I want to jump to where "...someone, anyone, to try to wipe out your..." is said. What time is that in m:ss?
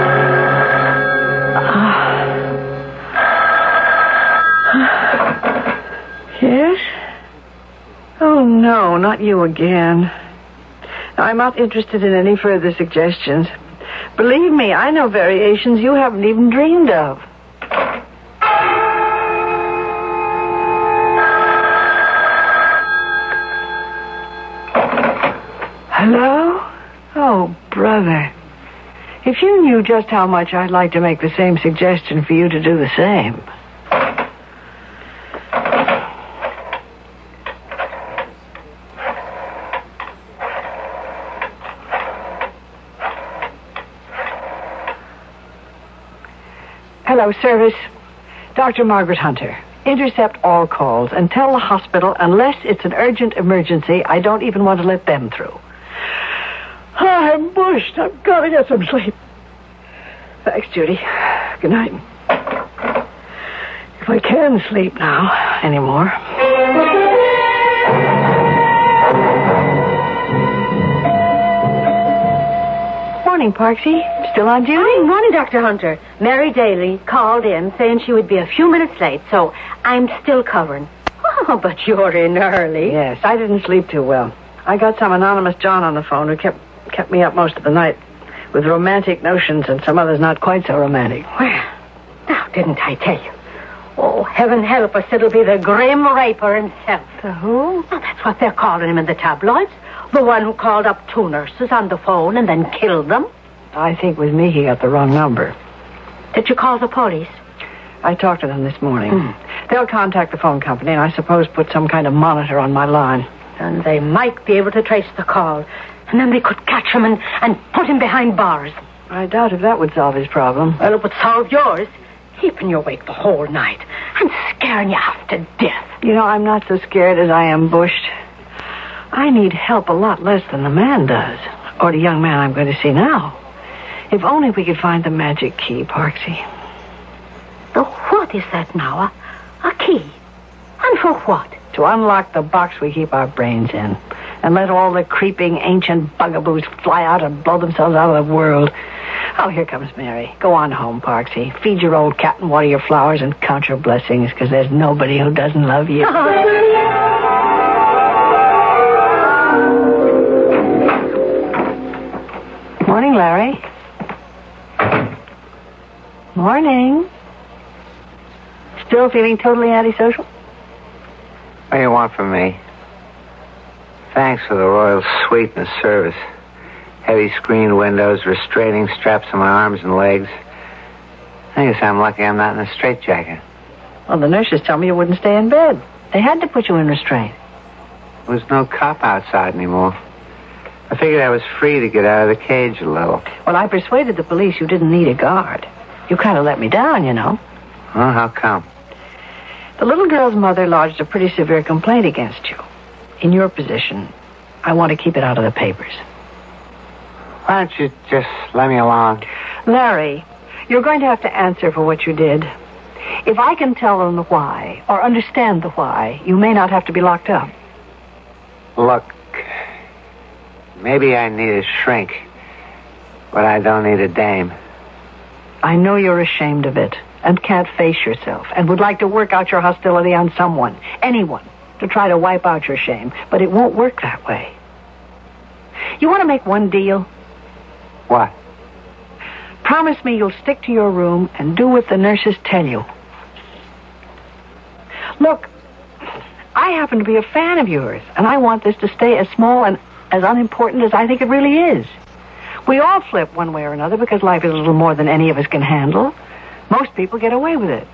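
3:50.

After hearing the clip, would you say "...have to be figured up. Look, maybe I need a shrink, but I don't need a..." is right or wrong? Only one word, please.
wrong.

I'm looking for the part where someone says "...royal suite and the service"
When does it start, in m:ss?
2:54.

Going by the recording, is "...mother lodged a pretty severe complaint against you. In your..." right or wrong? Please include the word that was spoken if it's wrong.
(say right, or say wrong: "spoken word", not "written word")
right.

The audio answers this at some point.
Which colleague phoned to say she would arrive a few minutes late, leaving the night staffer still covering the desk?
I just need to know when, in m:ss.
1:16.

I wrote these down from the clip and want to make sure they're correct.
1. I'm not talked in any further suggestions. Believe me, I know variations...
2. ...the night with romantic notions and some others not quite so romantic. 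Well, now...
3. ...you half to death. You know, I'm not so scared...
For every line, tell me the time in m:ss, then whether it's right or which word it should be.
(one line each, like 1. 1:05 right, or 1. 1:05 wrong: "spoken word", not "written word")
1. 0:11 wrong: "interested", not "talked"
2. 1:27 right
3. 2:04 right.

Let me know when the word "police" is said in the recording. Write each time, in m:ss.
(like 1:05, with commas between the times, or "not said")
1:46, 3:14.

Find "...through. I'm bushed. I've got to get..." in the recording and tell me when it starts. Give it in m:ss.
0:55.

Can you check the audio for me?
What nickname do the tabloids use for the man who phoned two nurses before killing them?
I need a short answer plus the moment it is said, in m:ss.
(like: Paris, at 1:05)
the Grim Reaper, at 1:35.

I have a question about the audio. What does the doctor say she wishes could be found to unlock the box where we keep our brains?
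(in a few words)
the magic key.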